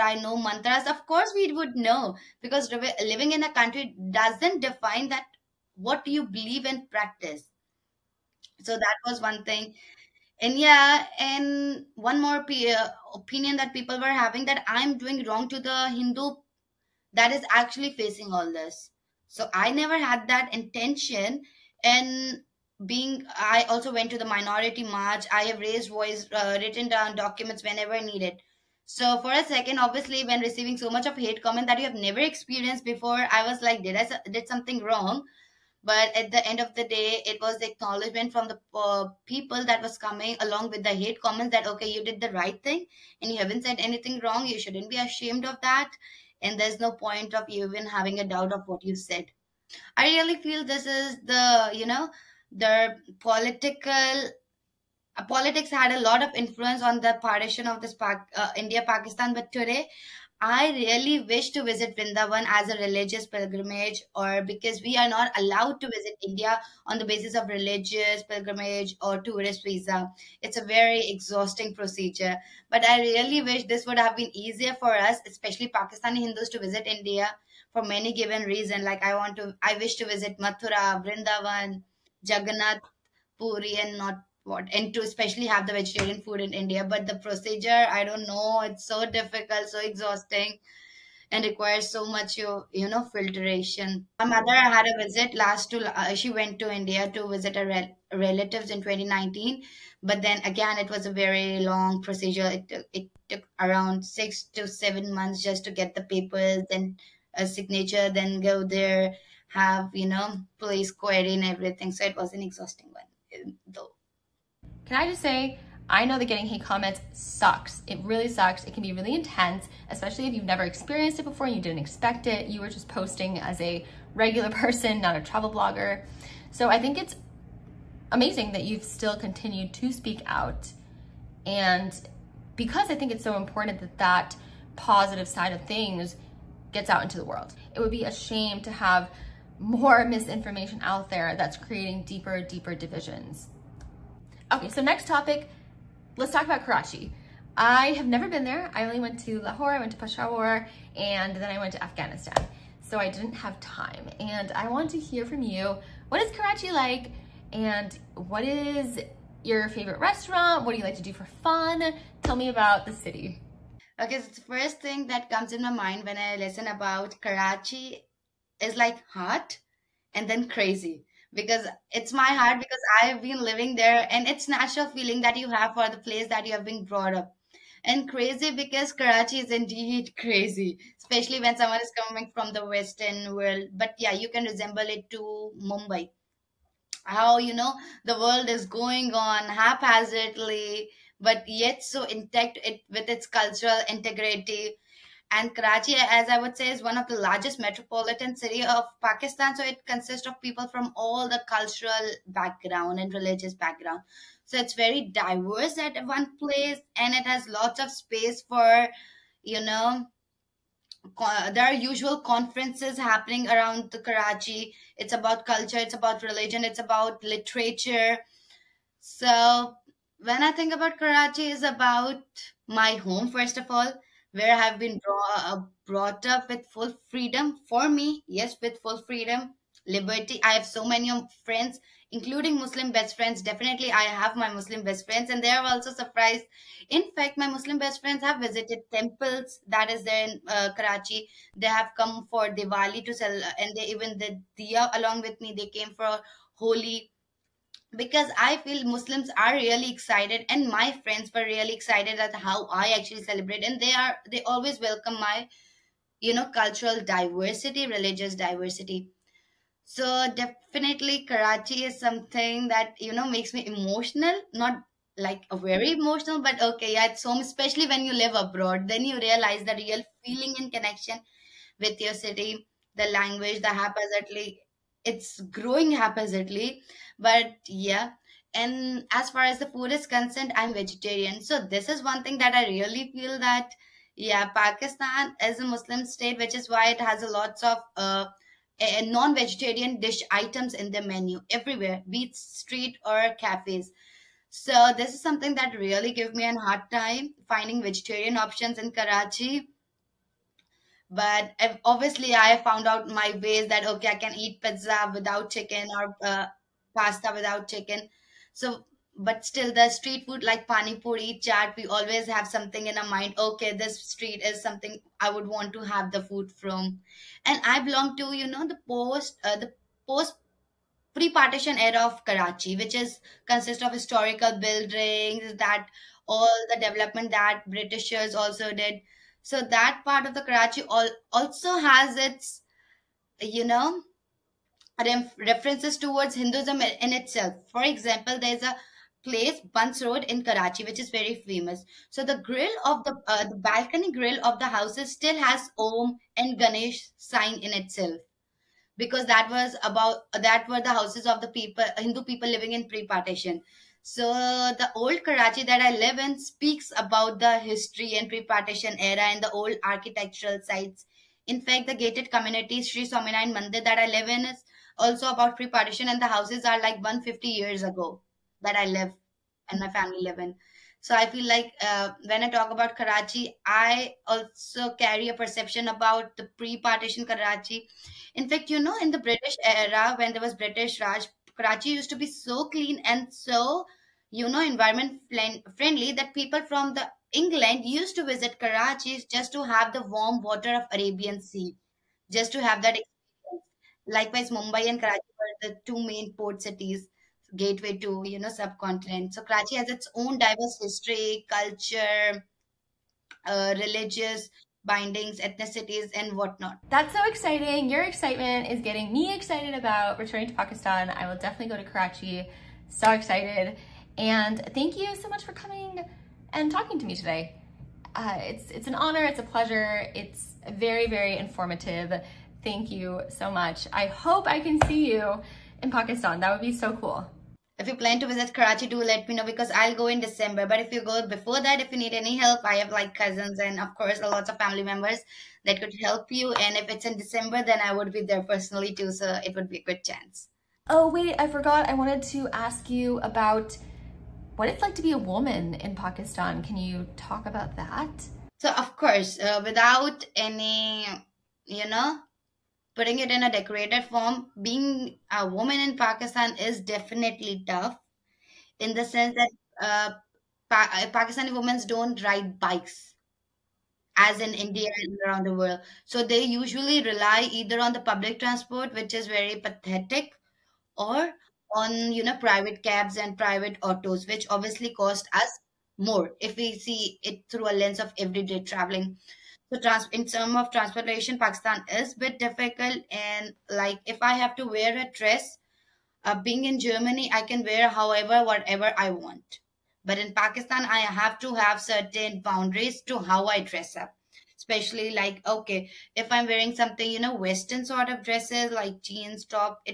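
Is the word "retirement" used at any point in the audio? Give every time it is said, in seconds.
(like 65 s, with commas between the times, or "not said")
not said.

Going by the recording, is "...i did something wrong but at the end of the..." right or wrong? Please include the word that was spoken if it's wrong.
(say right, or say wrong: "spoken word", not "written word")
right.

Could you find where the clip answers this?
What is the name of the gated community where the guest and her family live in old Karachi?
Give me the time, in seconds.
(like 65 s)
362 s.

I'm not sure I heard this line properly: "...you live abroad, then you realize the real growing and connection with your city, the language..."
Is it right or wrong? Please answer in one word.
wrong.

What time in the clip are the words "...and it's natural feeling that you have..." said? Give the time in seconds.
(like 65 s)
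174 s.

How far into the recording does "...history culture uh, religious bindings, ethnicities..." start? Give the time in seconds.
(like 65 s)
400 s.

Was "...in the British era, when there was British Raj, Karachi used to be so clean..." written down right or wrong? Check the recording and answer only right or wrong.
right.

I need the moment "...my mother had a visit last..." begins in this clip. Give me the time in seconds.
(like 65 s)
94 s.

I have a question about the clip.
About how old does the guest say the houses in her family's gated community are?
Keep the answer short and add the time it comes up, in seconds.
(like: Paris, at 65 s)
150 years, at 367 s.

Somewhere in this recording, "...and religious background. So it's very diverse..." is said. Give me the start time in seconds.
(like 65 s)
203 s.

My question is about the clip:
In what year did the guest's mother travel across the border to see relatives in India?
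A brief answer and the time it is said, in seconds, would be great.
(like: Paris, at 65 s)
2019, at 98 s.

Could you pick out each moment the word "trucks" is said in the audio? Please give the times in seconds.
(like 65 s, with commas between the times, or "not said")
not said.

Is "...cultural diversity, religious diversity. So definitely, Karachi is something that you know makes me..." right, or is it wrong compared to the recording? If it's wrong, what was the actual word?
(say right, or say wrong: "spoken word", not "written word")
right.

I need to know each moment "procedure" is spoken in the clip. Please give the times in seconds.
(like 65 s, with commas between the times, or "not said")
71 s, 87 s, 102 s.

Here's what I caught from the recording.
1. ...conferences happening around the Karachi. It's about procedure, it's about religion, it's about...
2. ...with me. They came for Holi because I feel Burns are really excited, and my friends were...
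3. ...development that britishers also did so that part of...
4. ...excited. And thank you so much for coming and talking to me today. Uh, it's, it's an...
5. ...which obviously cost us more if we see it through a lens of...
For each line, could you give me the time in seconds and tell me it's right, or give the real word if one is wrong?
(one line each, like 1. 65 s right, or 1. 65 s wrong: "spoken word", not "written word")
1. 212 s wrong: "culture", not "procedure"
2. 245 s wrong: "Muslims", not "Burns"
3. 326 s right
4. 413 s right
5. 474 s right.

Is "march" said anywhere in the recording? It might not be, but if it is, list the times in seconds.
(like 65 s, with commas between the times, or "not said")
24 s.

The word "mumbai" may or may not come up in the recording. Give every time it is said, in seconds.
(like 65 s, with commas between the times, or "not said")
185 s, 394 s.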